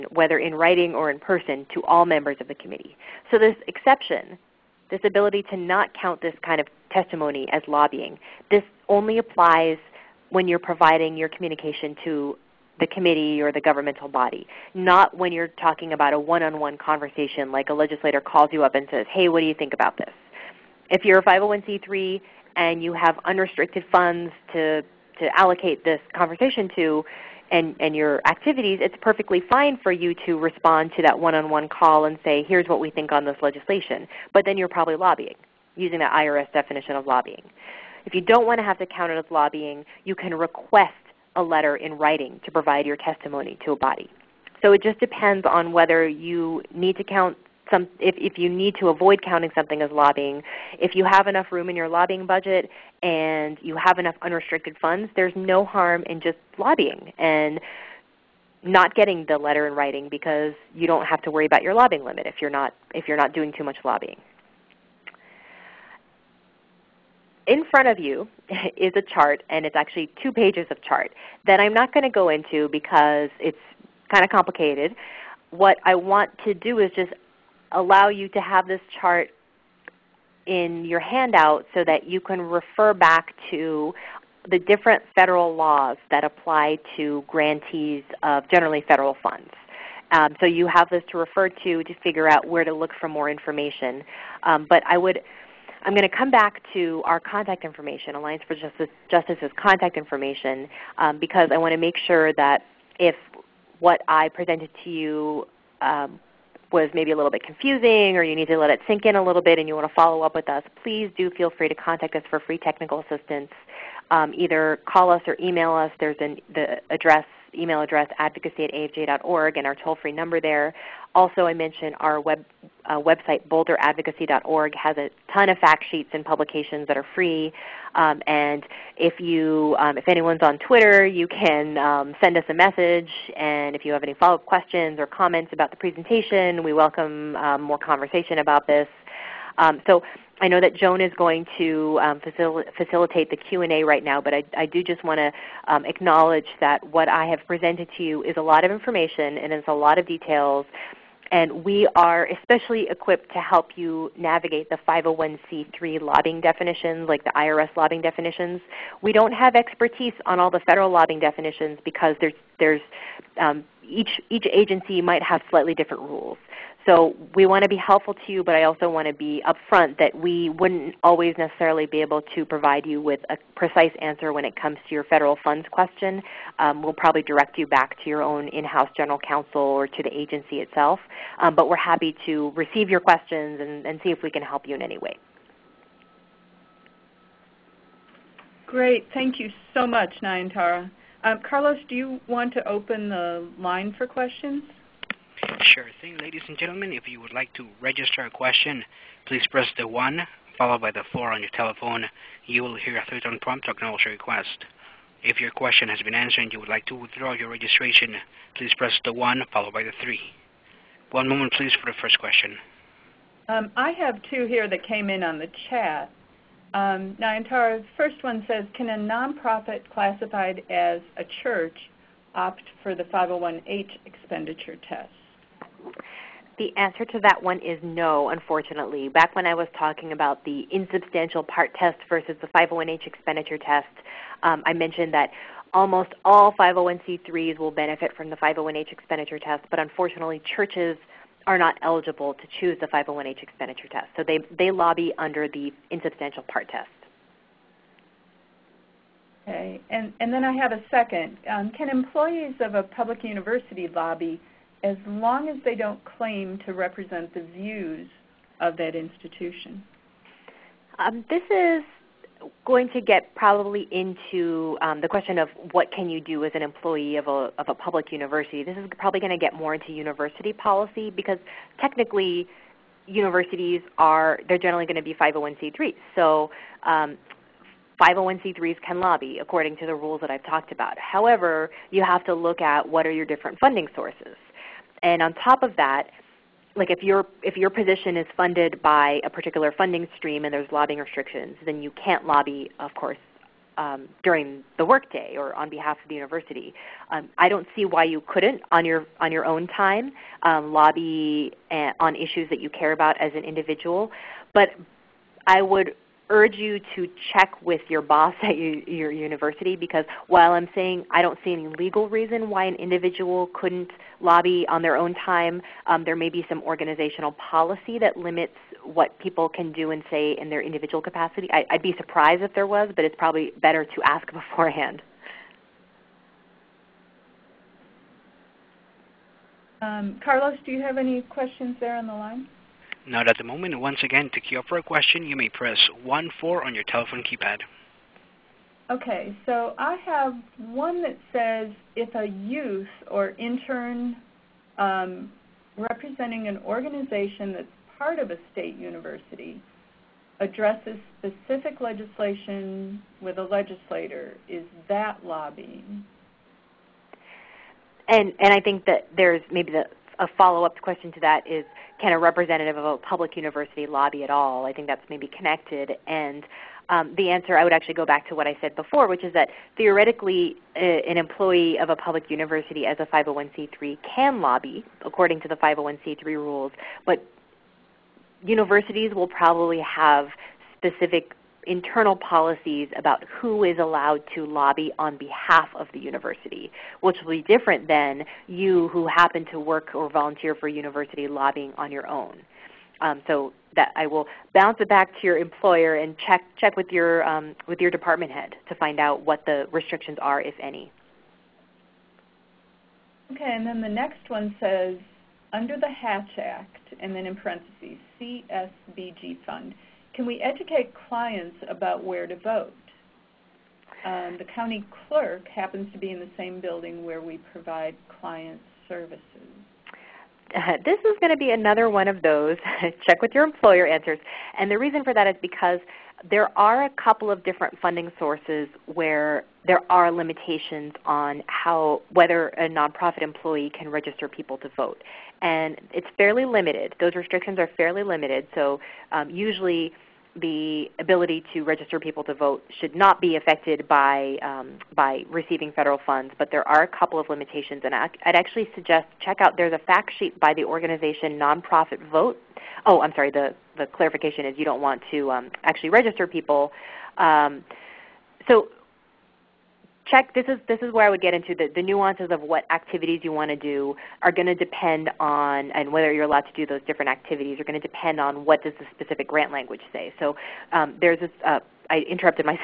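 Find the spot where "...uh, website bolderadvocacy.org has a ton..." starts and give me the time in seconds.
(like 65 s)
122 s.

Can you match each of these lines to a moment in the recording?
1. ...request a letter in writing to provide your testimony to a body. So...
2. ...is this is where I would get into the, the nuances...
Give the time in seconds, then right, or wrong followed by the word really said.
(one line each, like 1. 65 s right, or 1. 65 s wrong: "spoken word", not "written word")
1. 40 s right
2. 460 s right.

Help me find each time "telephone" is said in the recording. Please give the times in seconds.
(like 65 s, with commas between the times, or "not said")
201 s, 336 s.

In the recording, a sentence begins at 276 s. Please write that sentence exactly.
So um, 501c3s can lobby according to the rules that I've talked about.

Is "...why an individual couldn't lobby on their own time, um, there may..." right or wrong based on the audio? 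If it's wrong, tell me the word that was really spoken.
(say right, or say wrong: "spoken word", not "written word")
right.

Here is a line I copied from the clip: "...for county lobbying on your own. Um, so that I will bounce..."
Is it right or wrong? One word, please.
wrong.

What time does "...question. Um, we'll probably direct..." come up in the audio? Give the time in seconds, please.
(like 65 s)
175 s.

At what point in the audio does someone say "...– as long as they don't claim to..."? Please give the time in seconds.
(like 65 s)
254 s.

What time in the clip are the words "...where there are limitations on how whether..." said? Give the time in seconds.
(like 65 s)
428 s.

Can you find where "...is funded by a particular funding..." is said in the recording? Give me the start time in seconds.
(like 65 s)
288 s.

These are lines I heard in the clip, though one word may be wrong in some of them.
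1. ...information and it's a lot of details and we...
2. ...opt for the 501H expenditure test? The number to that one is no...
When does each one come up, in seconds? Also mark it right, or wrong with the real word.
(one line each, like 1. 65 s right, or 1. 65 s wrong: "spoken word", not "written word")
1. 148 s right
2. 222 s wrong: "answer", not "number".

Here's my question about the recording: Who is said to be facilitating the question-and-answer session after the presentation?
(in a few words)
Joan.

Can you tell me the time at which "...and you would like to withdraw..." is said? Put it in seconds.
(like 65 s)
206 s.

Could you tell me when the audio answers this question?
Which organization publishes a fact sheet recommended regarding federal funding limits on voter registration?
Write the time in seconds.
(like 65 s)
451 s.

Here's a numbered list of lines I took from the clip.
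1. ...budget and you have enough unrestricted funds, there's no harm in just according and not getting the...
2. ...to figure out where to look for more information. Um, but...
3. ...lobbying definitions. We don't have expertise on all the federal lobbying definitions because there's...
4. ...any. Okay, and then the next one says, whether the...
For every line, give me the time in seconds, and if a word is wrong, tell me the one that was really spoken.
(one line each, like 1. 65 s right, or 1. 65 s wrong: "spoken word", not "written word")
1. 52 s wrong: "lobbying", not "according"
2. 91 s right
3. 157 s right
4. 400 s wrong: "under", not "whether".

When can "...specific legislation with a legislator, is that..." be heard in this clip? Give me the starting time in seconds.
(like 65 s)
351 s.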